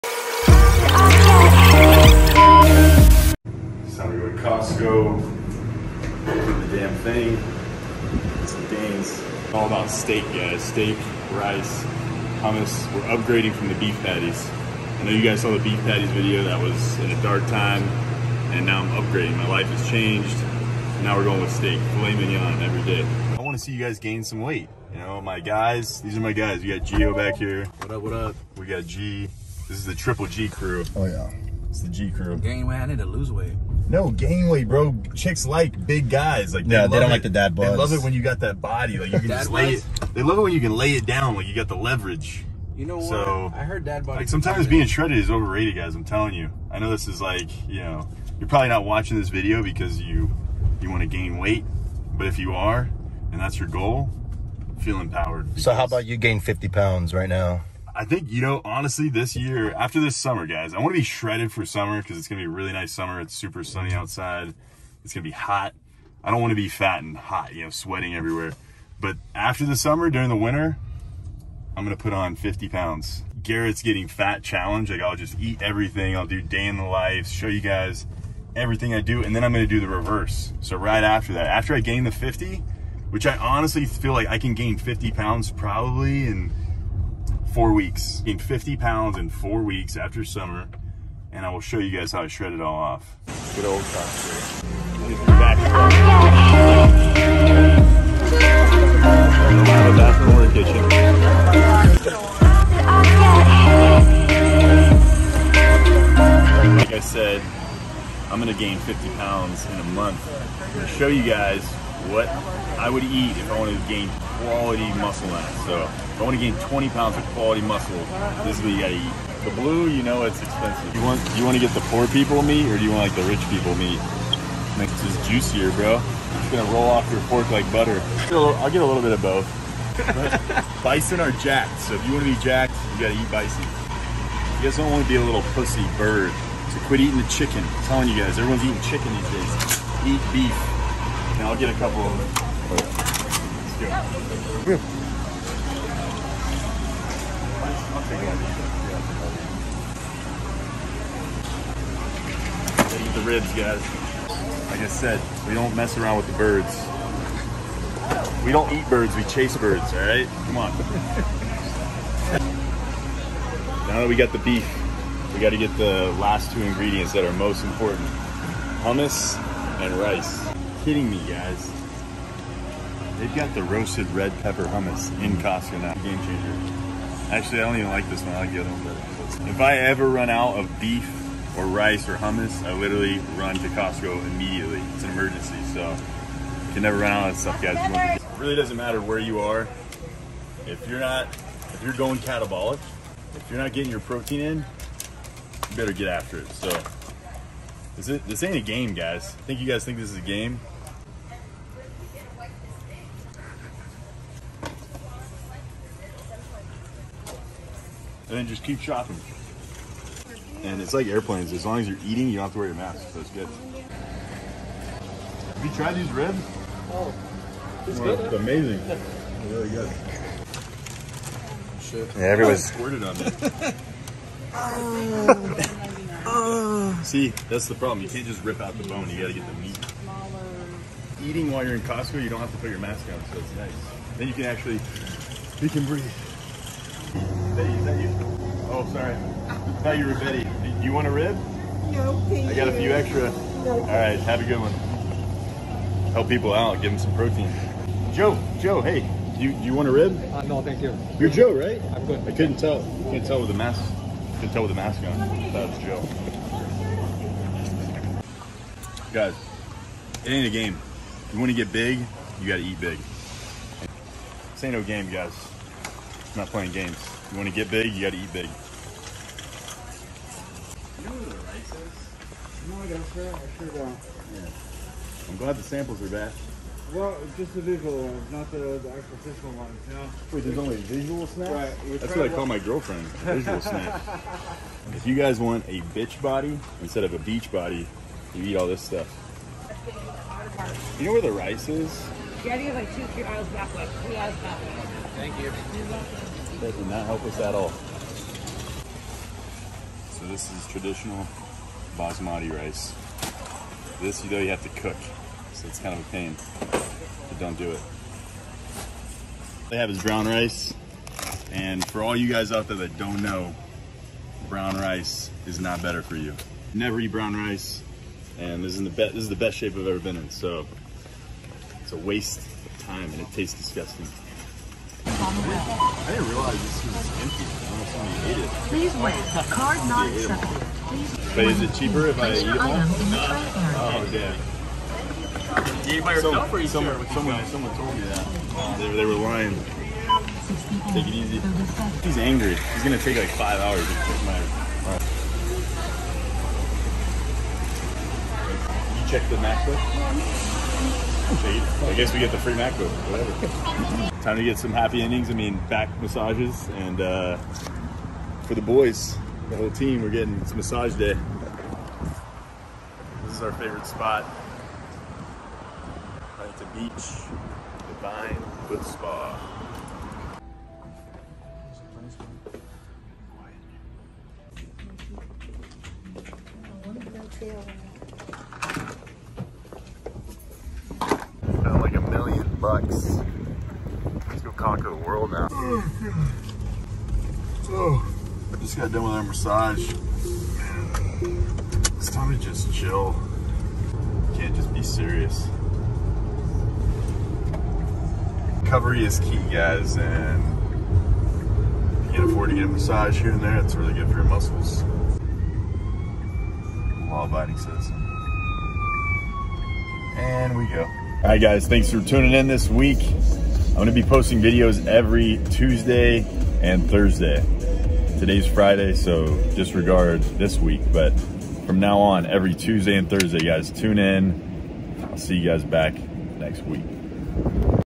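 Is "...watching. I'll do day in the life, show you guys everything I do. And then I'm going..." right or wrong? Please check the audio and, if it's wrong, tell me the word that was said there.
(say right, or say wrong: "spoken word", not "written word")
wrong: "everything", not "watching".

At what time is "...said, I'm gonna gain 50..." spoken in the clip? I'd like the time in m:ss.
1:47.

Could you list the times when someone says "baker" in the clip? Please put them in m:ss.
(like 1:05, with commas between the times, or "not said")
not said.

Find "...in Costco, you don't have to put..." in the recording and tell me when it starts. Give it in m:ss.
3:51.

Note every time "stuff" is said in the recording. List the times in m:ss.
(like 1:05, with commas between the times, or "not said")
3:07, 4:48.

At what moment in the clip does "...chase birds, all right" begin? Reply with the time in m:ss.
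2:39.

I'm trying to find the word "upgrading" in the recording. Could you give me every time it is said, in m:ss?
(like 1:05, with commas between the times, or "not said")
0:13, 0:19.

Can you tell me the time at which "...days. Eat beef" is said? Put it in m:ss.
2:19.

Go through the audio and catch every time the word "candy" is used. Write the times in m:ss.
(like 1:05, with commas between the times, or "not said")
not said.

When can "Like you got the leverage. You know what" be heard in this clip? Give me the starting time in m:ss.
0:41.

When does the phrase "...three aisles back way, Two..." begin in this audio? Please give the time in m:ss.
4:53.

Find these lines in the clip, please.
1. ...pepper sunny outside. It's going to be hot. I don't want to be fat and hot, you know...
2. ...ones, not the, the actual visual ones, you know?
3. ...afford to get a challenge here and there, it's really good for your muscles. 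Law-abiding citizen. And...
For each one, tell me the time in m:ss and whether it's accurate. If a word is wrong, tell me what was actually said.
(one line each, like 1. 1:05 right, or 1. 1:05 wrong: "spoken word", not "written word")
1. 1:03 wrong: "super", not "pepper"
2. 4:38 wrong: "physical", not "visual"
3. 6:42 wrong: "massage", not "challenge".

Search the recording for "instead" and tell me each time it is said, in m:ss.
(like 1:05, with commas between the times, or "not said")
4:46.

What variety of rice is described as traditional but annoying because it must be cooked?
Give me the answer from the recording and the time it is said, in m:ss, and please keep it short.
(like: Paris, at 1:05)
Basmati, at 5:01.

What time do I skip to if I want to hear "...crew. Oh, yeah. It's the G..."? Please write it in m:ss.
0:30.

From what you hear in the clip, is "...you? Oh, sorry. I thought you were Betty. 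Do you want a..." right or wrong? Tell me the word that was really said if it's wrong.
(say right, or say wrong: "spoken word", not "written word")
right.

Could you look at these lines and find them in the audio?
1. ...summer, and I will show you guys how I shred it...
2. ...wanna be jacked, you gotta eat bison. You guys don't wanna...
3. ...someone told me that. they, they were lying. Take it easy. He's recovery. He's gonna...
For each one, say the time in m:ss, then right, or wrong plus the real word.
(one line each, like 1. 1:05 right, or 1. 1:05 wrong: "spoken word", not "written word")
1. 1:30 right
2. 2:12 right
3. 5:37 wrong: "angry", not "recovery".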